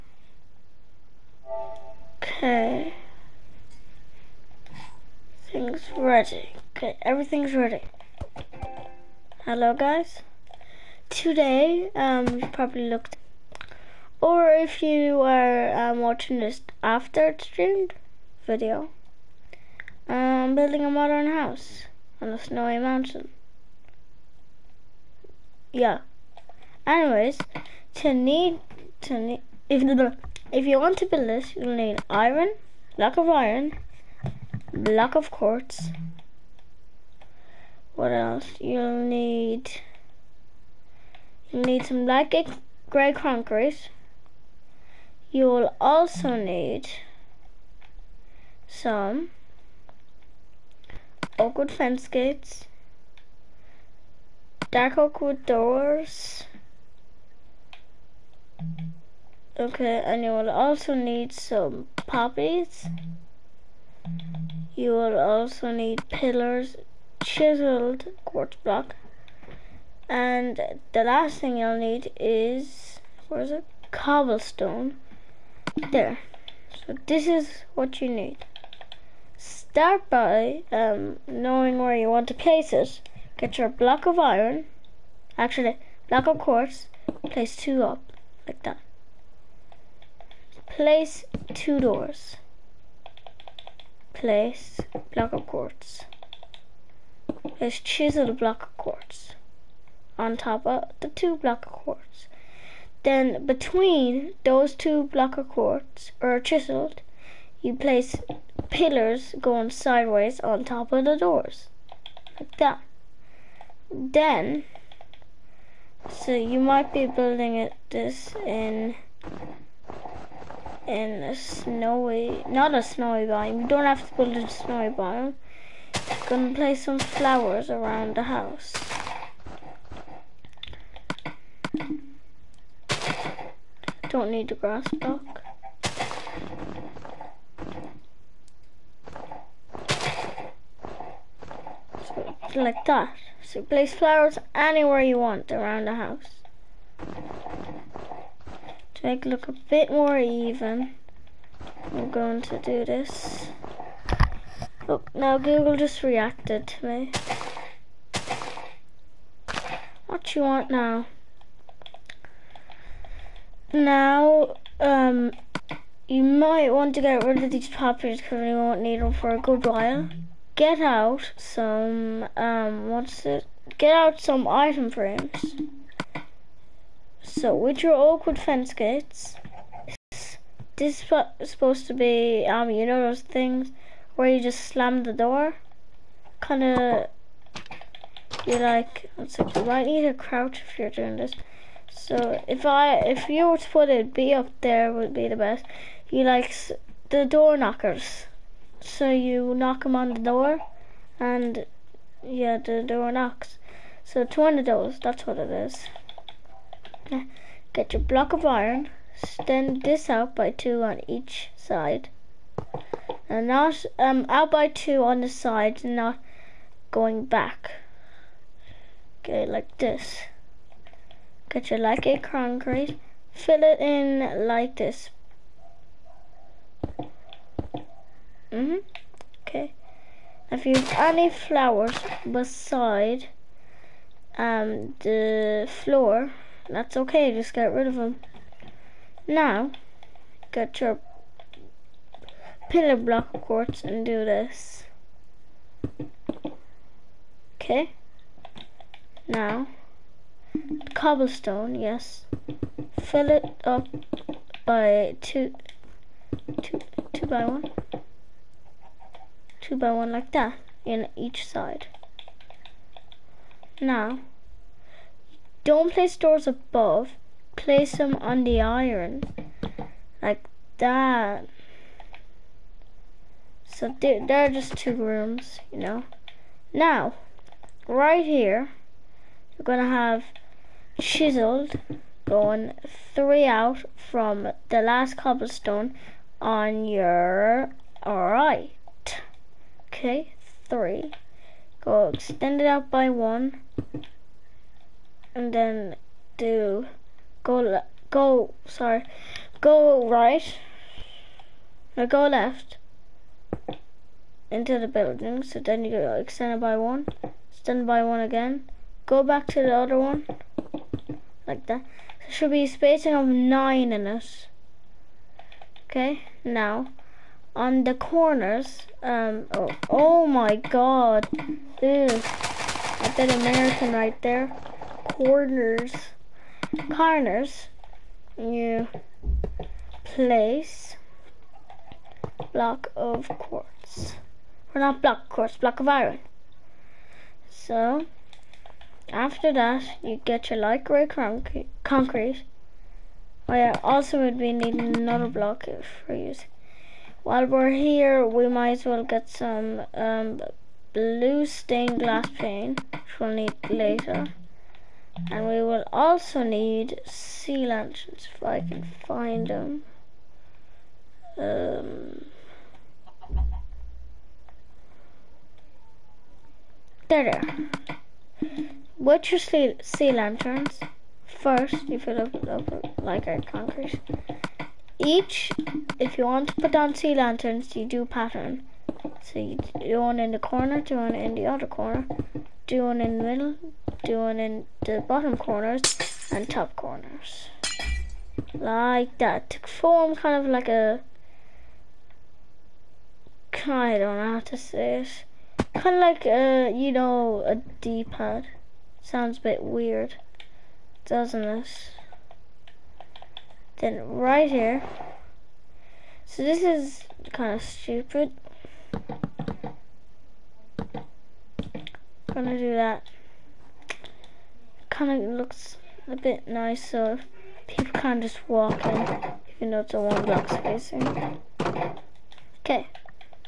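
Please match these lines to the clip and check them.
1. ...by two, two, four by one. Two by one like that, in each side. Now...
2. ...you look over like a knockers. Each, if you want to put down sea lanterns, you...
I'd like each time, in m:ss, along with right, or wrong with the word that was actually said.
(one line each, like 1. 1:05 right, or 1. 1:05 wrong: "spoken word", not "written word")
1. 4:14 wrong: "two", not "four"
2. 6:12 wrong: "conquerors", not "knockers".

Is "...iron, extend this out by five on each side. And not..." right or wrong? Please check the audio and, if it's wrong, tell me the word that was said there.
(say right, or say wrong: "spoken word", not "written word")
wrong: "two", not "five".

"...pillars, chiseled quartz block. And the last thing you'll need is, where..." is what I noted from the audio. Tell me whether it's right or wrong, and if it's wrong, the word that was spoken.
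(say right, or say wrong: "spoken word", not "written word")
right.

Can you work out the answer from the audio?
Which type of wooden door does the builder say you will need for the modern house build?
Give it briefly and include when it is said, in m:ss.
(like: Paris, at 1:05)
dark oakwood doors, at 0:54.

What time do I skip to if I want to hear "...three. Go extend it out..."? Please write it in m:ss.
4:50.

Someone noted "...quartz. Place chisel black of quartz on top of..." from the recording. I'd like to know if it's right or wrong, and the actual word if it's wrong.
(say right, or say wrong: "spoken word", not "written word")
wrong: "block", not "black".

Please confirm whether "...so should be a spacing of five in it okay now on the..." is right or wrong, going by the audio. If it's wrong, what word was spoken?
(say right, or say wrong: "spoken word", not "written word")
wrong: "nine", not "five".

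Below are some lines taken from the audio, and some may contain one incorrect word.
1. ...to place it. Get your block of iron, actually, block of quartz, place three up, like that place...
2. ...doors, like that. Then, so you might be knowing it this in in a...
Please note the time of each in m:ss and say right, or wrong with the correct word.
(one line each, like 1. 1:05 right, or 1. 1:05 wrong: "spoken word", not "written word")
1. 1:22 wrong: "two", not "three"
2. 1:51 wrong: "building", not "knowing".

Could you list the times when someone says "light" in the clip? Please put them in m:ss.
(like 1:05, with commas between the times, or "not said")
3:41, 5:40.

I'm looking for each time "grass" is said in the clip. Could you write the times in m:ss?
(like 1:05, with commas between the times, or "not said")
2:14.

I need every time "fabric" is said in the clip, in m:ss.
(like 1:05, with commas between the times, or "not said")
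not said.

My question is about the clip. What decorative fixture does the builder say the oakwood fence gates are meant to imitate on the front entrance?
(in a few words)
door knockers.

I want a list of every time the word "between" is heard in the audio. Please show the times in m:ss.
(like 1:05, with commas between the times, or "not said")
1:43.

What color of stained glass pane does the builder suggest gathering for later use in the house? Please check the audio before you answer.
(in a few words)
blue.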